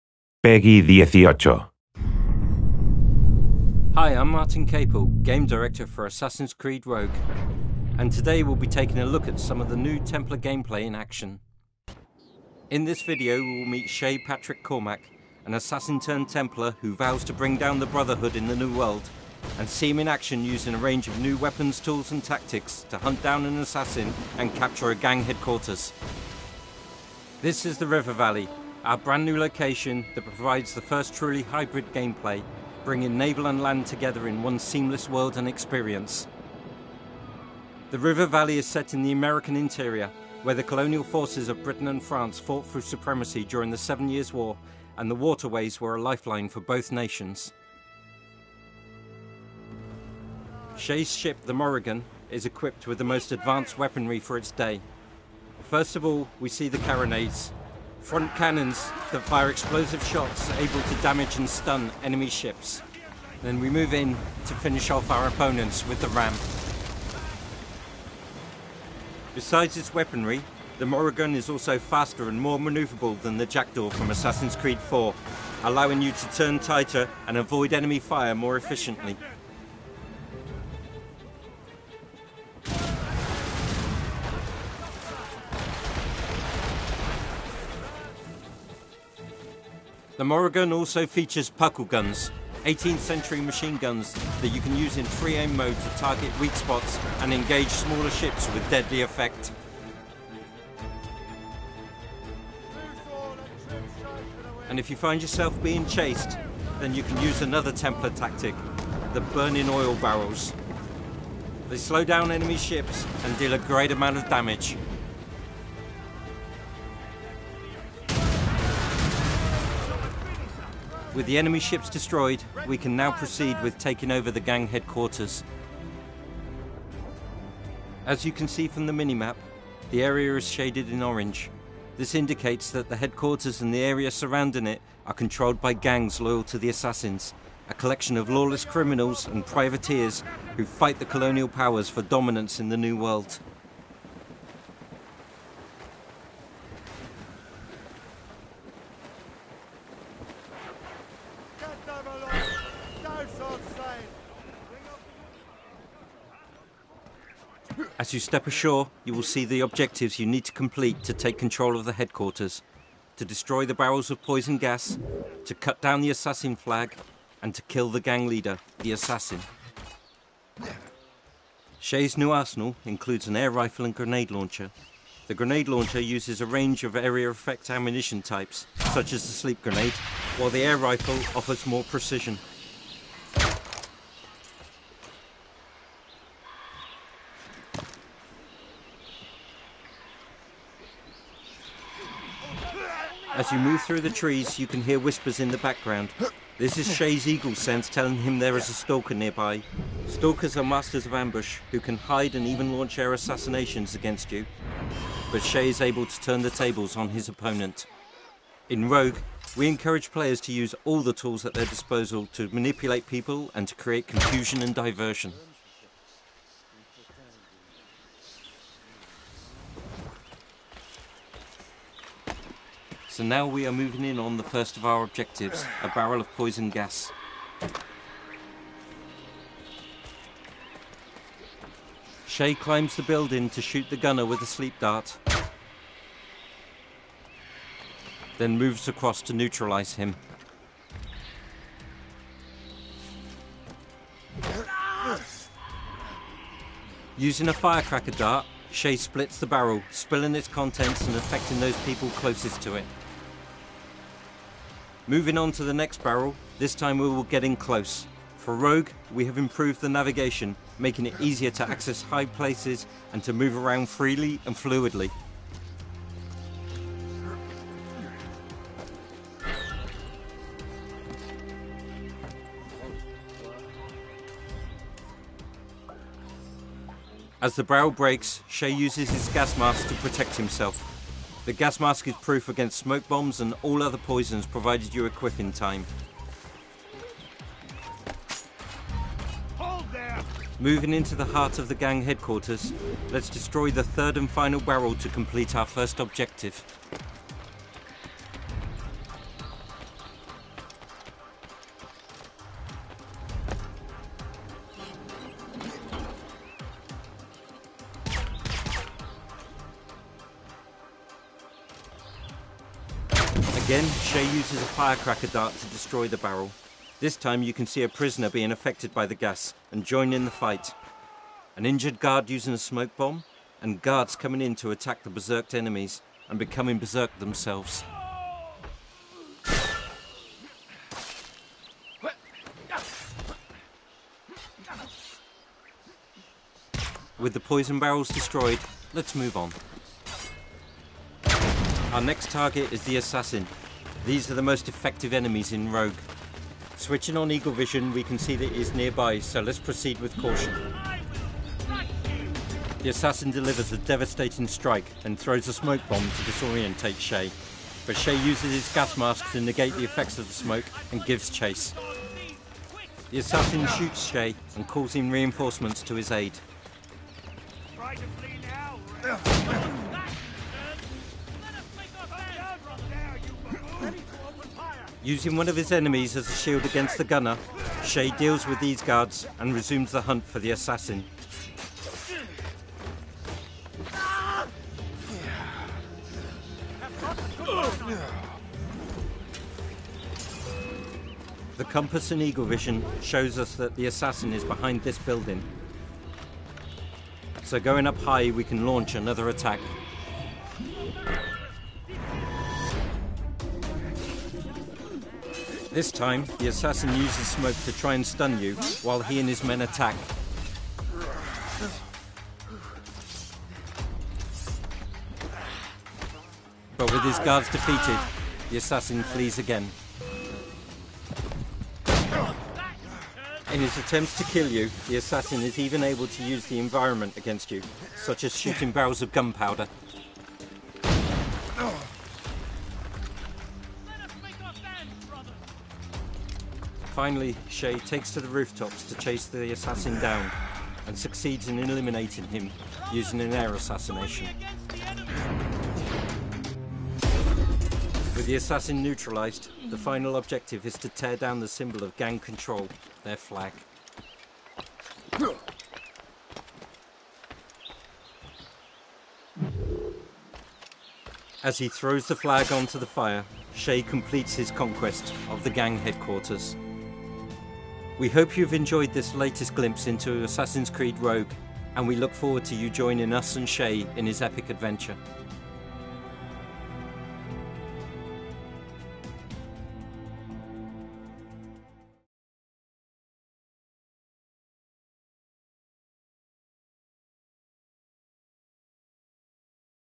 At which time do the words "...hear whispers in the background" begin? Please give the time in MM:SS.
03:14.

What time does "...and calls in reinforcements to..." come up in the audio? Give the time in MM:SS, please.
06:04.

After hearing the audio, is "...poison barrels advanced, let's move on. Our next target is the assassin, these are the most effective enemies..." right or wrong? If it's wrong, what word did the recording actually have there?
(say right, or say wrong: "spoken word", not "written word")
wrong: "destroyed", not "advanced".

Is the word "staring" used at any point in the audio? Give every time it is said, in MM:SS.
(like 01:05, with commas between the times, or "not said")
not said.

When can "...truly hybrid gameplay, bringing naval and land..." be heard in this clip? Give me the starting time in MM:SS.
00:31.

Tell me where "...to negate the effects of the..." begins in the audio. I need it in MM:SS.
05:59.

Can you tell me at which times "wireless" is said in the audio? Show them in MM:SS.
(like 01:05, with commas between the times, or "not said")
not said.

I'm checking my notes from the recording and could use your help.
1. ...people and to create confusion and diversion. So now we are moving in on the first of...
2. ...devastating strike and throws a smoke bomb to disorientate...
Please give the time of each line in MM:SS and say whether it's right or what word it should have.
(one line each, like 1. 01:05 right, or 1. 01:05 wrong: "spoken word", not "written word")
1. 03:33 right
2. 05:53 right.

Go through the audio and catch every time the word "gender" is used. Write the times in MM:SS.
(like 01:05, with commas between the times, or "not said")
not said.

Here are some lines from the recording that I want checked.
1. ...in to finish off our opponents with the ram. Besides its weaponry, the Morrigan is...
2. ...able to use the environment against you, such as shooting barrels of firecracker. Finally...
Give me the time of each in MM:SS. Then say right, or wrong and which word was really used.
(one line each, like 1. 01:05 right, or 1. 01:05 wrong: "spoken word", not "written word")
1. 01:03 right
2. 07:05 wrong: "gunpowder", not "firecracker".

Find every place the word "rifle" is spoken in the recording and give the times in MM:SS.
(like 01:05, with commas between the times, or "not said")
02:53, 03:00.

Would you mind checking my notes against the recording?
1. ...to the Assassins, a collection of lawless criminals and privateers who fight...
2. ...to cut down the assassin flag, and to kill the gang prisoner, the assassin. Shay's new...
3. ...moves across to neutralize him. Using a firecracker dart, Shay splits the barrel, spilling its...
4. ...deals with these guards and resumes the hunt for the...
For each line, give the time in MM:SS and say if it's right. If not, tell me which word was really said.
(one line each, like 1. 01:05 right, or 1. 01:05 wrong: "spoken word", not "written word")
1. 02:16 right
2. 02:45 wrong: "leader", not "prisoner"
3. 03:58 right
4. 06:18 right.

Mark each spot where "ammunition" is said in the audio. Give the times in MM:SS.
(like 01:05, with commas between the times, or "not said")
02:57.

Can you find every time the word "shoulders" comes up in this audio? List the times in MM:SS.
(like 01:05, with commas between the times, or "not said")
not said.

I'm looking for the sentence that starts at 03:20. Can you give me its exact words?
Stalkers are masters of ambush who can hide and even launch air assassinations against you.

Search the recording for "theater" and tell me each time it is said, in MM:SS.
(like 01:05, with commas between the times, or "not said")
not said.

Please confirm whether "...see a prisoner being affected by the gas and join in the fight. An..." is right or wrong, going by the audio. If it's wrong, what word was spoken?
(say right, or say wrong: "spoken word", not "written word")
right.